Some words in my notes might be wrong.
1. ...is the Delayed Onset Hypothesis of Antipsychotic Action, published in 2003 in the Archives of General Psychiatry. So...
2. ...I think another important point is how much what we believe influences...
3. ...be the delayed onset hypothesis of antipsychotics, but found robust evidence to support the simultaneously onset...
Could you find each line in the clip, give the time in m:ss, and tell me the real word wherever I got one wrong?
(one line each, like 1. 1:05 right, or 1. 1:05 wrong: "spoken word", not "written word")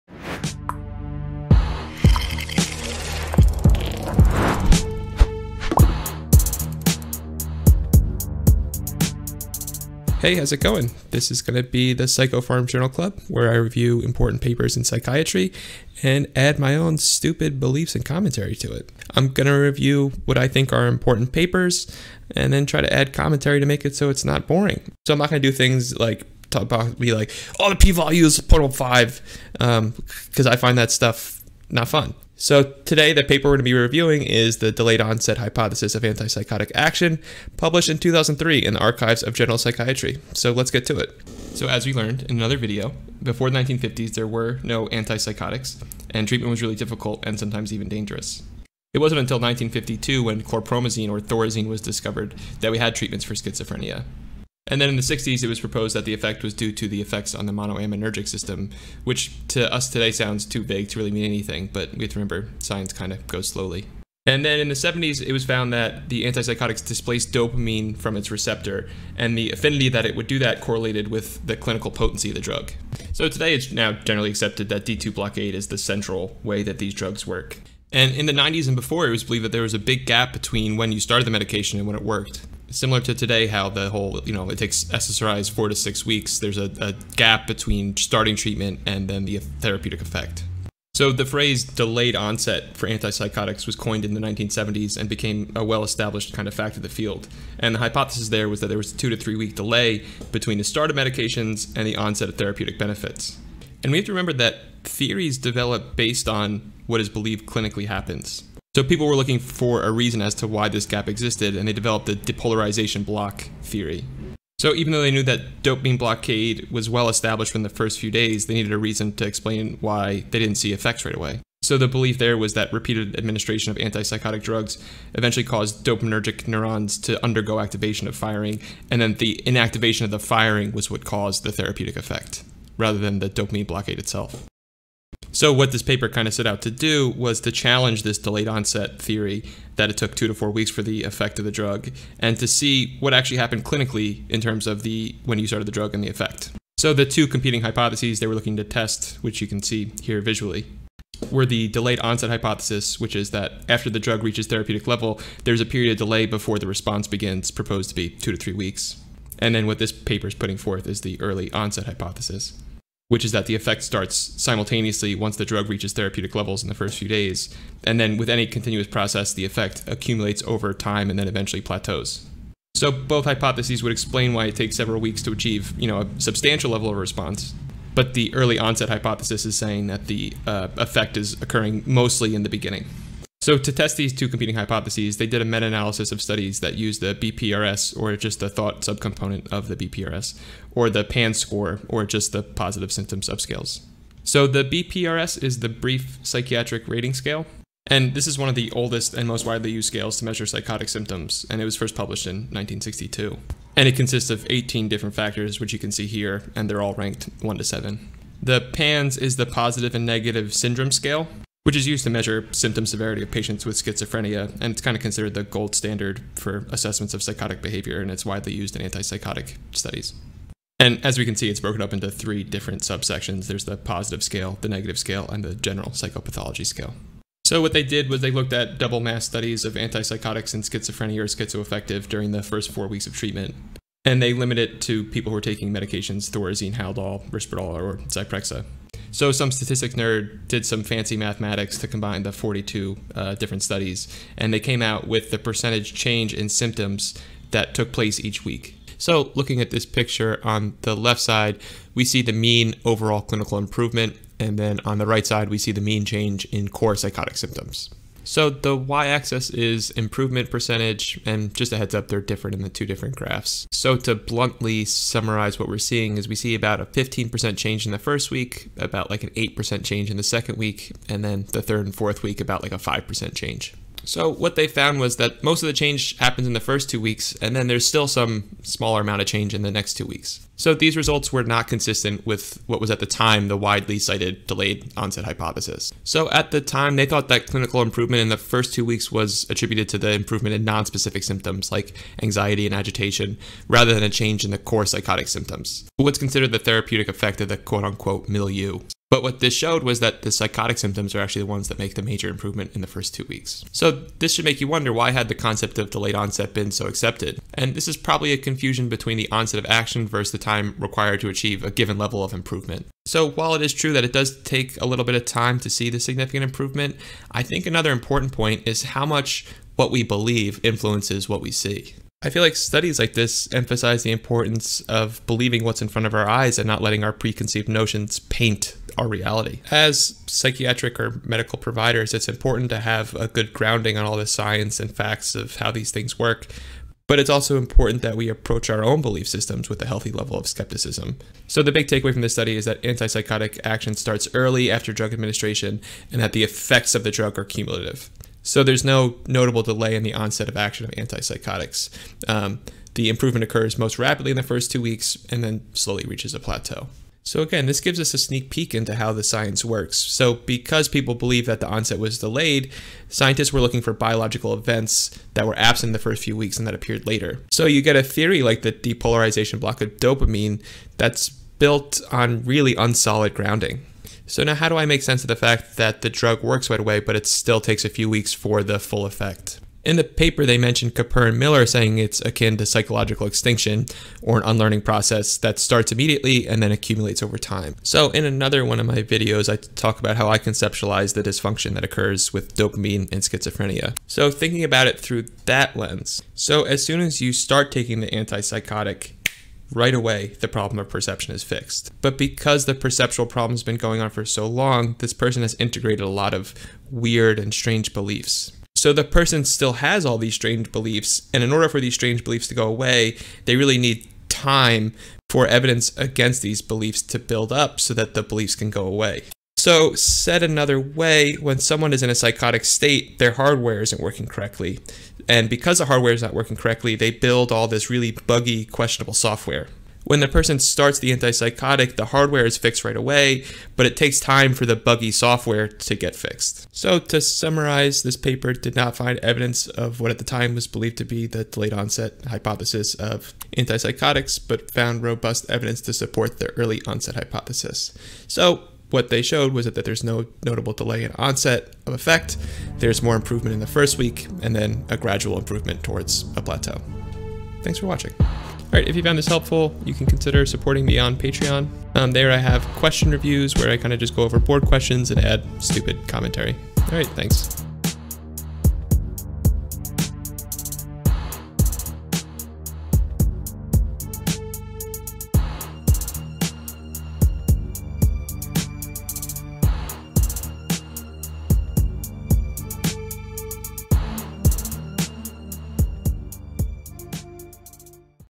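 1. 0:34 right
2. 5:17 right
3. 7:21 wrong: "early", not "simultaneously".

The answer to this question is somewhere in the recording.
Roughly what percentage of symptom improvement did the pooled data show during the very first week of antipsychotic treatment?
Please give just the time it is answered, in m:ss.
4:26.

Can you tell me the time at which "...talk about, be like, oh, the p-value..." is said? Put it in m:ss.
0:26.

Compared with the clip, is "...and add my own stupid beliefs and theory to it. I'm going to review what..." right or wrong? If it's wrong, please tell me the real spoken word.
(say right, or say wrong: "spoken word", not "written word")
wrong: "commentary", not "theory".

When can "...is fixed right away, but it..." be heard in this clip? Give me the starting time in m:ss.
7:12.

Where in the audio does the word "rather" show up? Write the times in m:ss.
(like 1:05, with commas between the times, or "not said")
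2:12, 4:53.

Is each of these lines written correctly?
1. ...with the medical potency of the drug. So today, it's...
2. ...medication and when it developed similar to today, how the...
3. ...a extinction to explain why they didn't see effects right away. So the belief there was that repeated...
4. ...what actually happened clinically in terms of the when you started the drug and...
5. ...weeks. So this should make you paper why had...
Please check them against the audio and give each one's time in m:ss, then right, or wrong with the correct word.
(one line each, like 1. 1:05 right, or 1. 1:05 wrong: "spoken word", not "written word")
1. 1:11 wrong: "clinical", not "medical"
2. 1:21 wrong: "worked", not "developed"
3. 1:58 wrong: "reason", not "extinction"
4. 2:22 right
5. 5:03 wrong: "wonder", not "paper".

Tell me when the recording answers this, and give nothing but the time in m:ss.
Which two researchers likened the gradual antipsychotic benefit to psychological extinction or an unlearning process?
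6:20.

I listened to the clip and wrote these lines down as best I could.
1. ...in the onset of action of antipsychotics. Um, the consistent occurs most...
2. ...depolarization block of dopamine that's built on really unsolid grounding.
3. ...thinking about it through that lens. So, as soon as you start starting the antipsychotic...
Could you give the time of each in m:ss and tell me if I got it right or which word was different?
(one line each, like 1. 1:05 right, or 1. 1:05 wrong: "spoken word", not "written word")
1. 5:49 wrong: "improvement", not "consistent"
2. 6:08 right
3. 6:34 wrong: "taking", not "starting".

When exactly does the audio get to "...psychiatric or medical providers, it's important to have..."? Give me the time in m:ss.
5:30.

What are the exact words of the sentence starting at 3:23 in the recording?
And it consists of 18 different factors, which you can see here, and they're all ranked 1 to 7.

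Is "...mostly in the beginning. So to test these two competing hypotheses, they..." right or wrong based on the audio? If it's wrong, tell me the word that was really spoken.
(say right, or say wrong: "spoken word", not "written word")
right.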